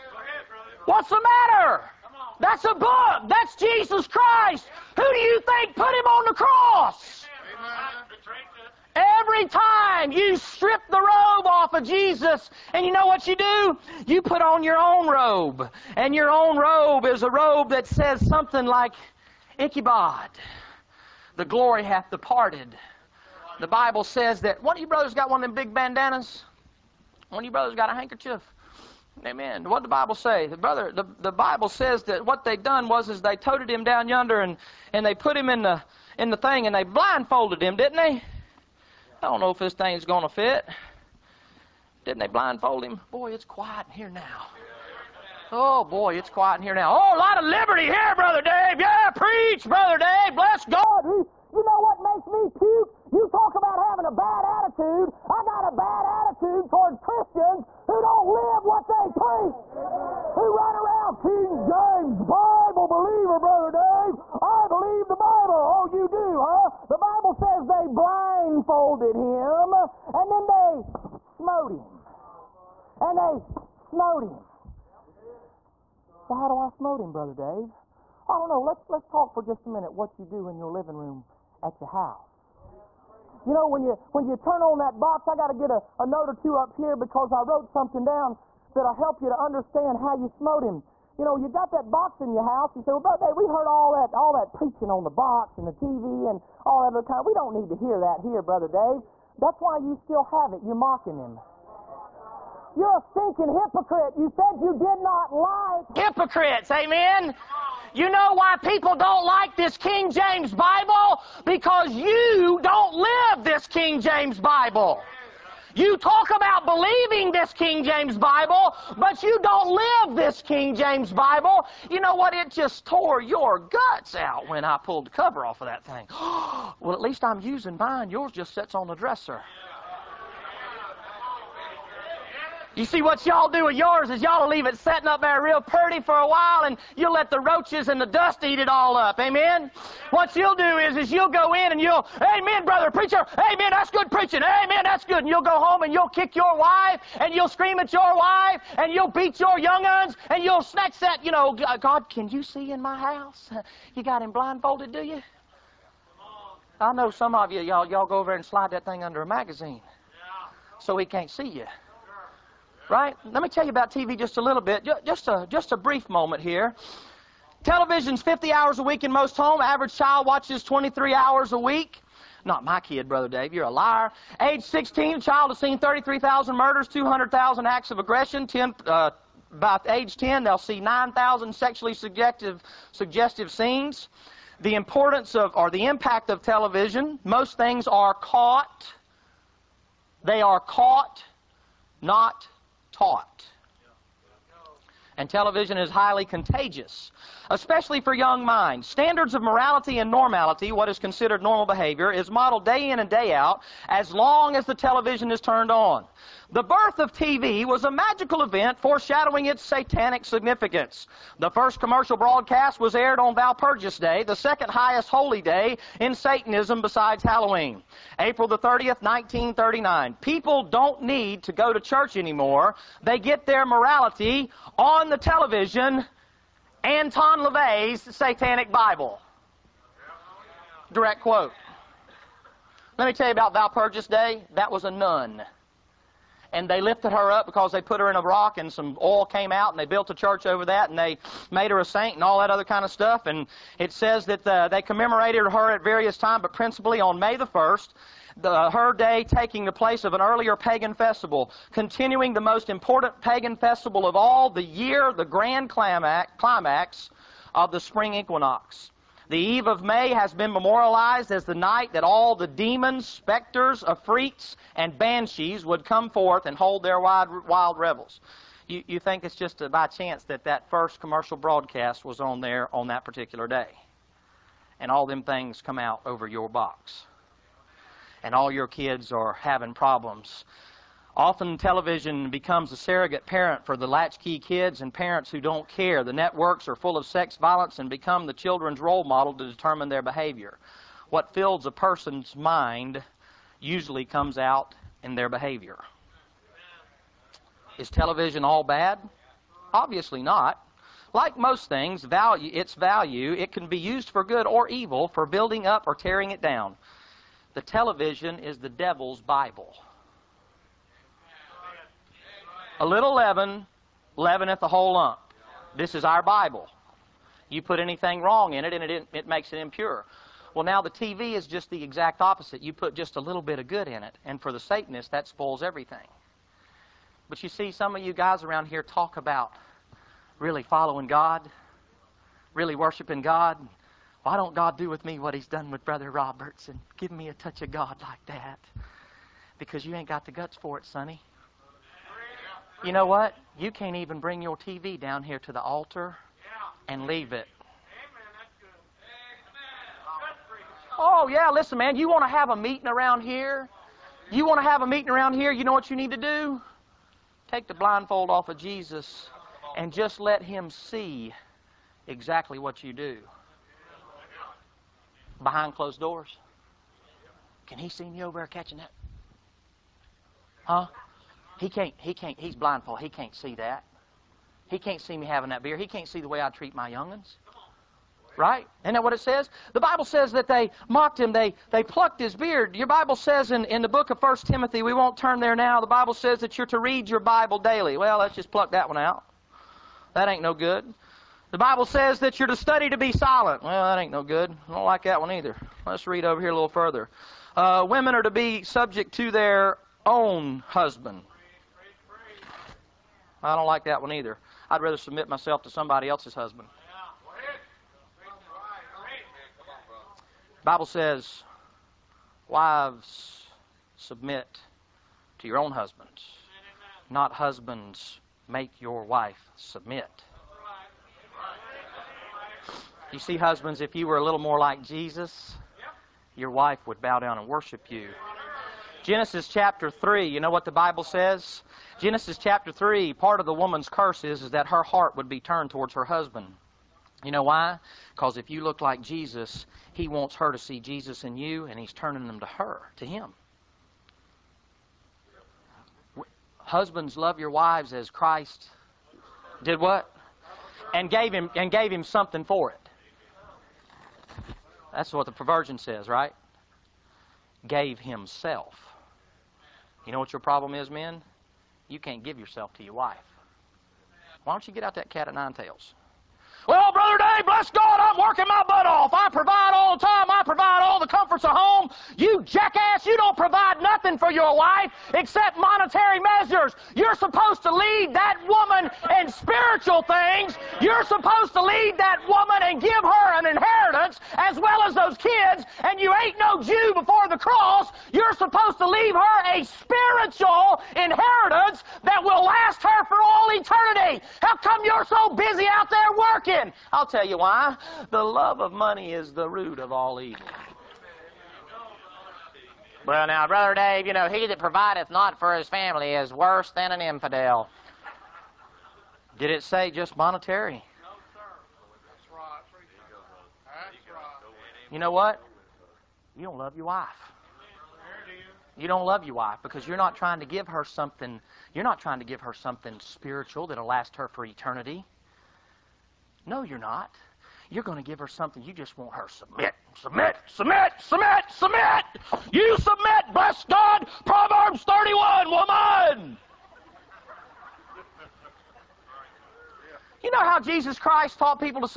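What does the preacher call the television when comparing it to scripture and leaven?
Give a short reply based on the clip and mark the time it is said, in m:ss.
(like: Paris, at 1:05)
The devil's Bible, at 5:08.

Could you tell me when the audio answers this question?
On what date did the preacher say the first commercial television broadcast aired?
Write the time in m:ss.
3:38.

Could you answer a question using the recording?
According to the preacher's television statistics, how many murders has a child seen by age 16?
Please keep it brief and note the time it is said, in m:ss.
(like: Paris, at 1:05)
33,000, at 2:55.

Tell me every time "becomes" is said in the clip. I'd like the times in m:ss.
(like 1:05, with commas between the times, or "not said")
4:42, 4:47.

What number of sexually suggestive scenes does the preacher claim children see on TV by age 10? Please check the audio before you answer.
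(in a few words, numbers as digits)
9,000.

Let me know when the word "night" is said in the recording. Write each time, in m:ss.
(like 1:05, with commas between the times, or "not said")
4:21.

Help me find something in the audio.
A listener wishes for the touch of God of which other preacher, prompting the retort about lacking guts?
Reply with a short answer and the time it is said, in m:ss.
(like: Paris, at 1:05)
Brother Roberts, at 5:35.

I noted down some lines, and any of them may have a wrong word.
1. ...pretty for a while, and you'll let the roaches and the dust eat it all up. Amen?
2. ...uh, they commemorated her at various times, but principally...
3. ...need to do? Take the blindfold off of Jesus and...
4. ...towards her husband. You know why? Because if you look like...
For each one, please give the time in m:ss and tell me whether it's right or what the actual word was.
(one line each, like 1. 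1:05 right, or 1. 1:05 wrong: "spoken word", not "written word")
1. 2:15 right
2. 4:04 right
3. 5:55 right
4. 7:15 right.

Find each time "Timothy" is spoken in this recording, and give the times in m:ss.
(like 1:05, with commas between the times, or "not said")
6:24.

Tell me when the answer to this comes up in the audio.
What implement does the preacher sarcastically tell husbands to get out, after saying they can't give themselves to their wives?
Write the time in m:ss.
7:45.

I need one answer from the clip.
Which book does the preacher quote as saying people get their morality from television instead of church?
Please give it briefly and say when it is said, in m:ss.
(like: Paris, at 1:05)
Anton LaVey's Satanic Bible, at 3:46.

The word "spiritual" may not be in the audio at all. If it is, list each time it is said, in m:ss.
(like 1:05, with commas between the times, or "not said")
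7:59, 8:09, 8:43.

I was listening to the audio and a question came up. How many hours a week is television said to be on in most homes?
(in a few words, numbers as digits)
50.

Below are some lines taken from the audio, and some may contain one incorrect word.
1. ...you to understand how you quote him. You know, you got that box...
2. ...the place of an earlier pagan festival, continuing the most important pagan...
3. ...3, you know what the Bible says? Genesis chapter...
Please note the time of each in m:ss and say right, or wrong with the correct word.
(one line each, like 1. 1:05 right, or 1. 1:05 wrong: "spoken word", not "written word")
1. 1:29 wrong: "smote", not "quote"
2. 4:09 right
3. 7:09 right.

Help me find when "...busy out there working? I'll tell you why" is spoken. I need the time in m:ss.
8:15.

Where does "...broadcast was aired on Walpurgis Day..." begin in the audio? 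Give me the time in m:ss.
3:32.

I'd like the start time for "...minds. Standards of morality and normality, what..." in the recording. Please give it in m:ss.
3:18.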